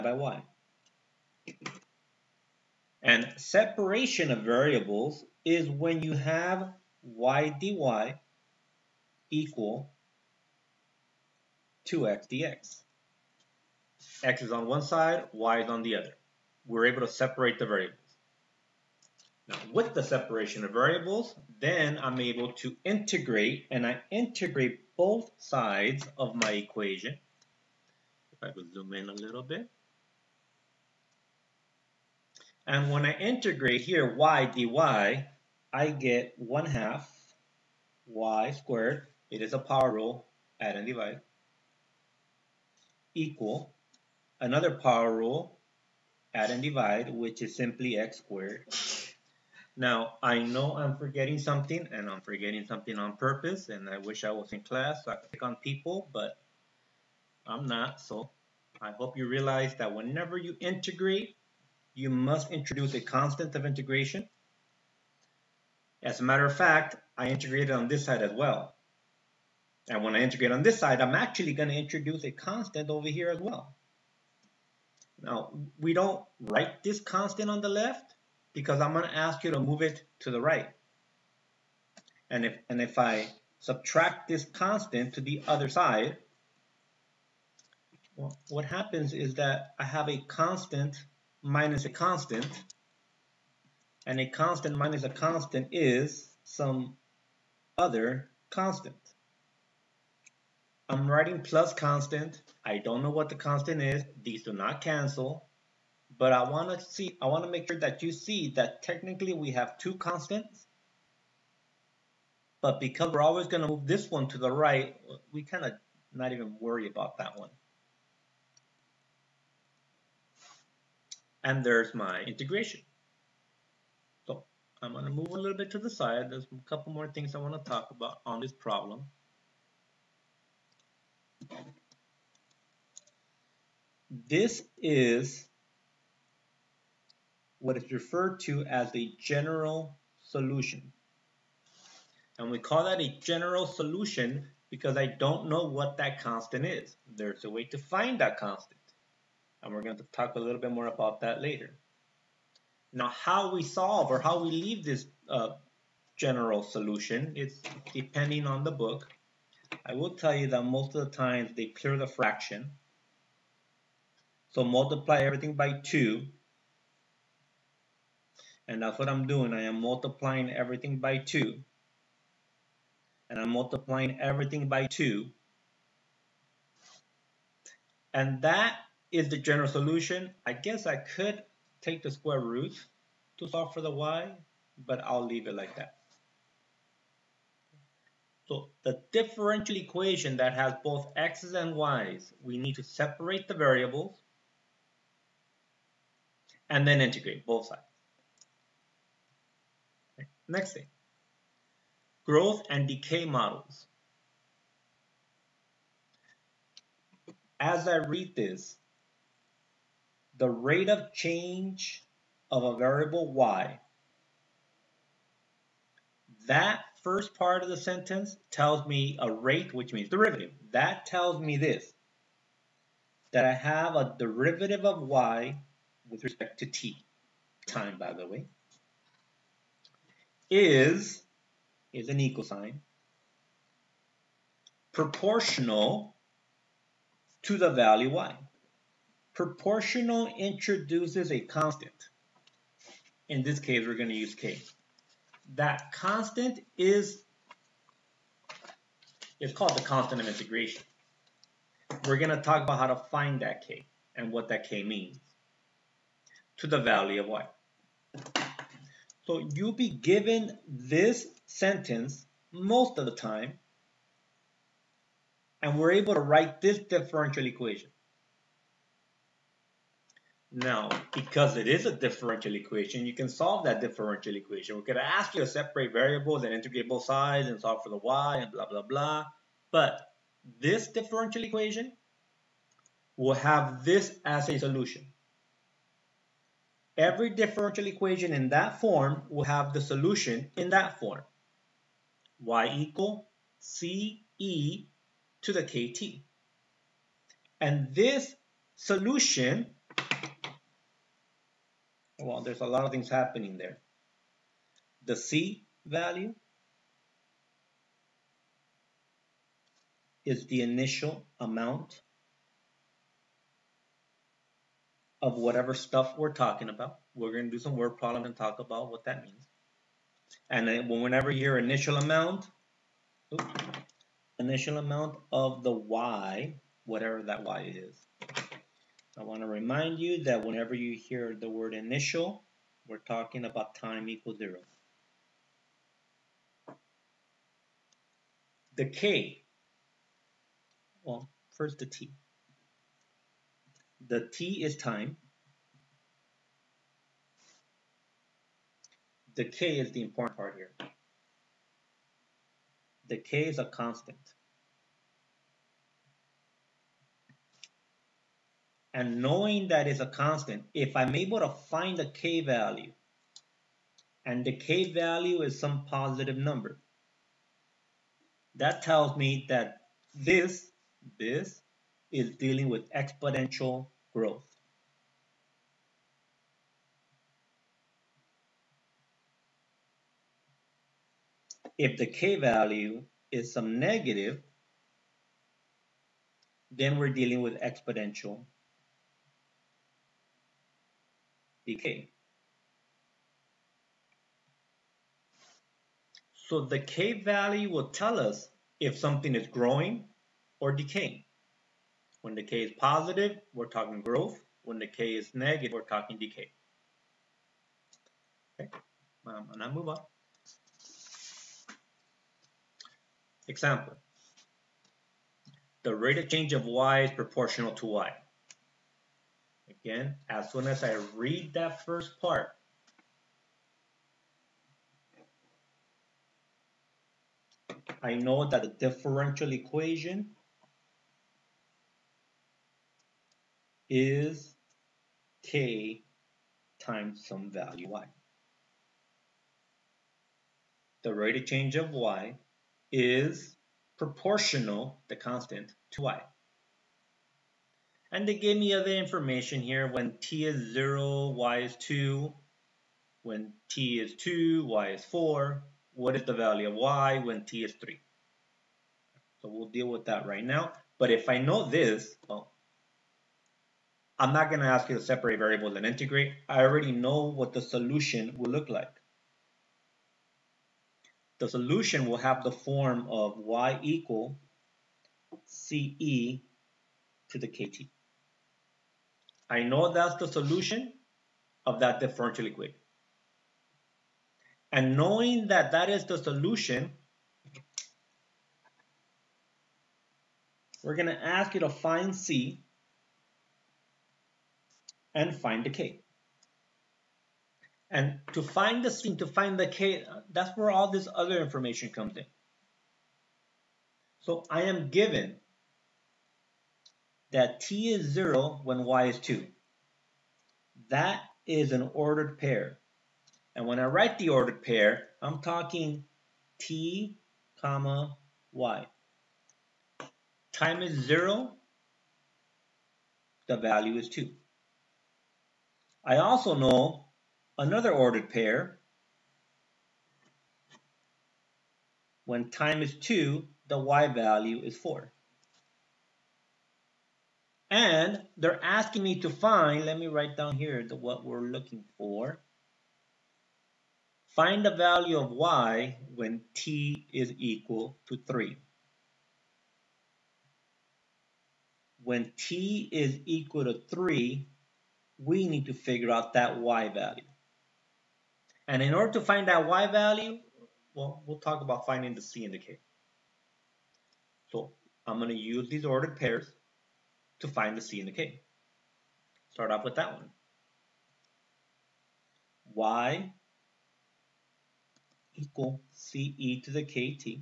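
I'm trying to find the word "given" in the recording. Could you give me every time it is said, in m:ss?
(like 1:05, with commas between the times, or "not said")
4:19, 8:24.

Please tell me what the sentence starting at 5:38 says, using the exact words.
The K, well, first the T.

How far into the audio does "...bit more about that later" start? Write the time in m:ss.
2:30.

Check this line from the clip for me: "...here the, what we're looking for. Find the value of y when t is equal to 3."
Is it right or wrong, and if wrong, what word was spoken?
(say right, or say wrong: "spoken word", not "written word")
right.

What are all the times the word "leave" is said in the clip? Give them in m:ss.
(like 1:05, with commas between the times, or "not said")
2:34, 3:05.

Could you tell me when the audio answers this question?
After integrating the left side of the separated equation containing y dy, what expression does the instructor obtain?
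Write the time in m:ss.
0:36.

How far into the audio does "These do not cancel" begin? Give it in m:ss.
1:44.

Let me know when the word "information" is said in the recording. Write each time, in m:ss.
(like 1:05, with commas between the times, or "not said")
7:28, 8:21.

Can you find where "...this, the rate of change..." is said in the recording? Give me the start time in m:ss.
3:28.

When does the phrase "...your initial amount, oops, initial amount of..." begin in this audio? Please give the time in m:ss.
5:21.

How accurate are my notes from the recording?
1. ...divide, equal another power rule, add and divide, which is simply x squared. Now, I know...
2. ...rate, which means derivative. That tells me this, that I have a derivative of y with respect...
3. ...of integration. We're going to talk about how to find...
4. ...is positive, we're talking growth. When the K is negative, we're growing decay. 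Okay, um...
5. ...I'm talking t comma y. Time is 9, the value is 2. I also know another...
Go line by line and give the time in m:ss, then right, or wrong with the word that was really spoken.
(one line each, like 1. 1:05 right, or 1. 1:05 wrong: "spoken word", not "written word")
1. 0:40 right
2. 3:39 right
3. 4:10 right
4. 6:42 wrong: "talking", not "growing"
5. 8:35 wrong: "0", not "9".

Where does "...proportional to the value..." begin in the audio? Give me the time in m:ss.
3:54.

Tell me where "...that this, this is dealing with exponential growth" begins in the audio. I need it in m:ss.
6:09.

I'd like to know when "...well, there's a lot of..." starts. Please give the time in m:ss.
5:02.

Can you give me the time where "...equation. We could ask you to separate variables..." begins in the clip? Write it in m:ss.
4:34.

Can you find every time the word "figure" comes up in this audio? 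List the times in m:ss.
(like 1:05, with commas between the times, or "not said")
9:15.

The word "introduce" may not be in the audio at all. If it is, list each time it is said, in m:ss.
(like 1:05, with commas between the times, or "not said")
1:02, 1:11, 4:00.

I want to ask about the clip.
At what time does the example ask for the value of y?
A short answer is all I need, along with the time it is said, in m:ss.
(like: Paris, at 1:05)
3, at 7:35.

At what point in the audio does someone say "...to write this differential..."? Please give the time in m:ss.
4:26.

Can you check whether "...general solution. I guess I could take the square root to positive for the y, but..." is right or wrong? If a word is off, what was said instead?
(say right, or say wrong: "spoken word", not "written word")
wrong: "solve", not "positive".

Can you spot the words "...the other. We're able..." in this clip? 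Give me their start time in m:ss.
0:15.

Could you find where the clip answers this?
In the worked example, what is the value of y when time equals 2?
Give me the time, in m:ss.
7:33.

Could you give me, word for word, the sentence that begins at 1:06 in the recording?
As a matter of fact, I integrated on this side as well.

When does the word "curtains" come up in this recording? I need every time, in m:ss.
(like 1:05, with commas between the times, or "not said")
not said.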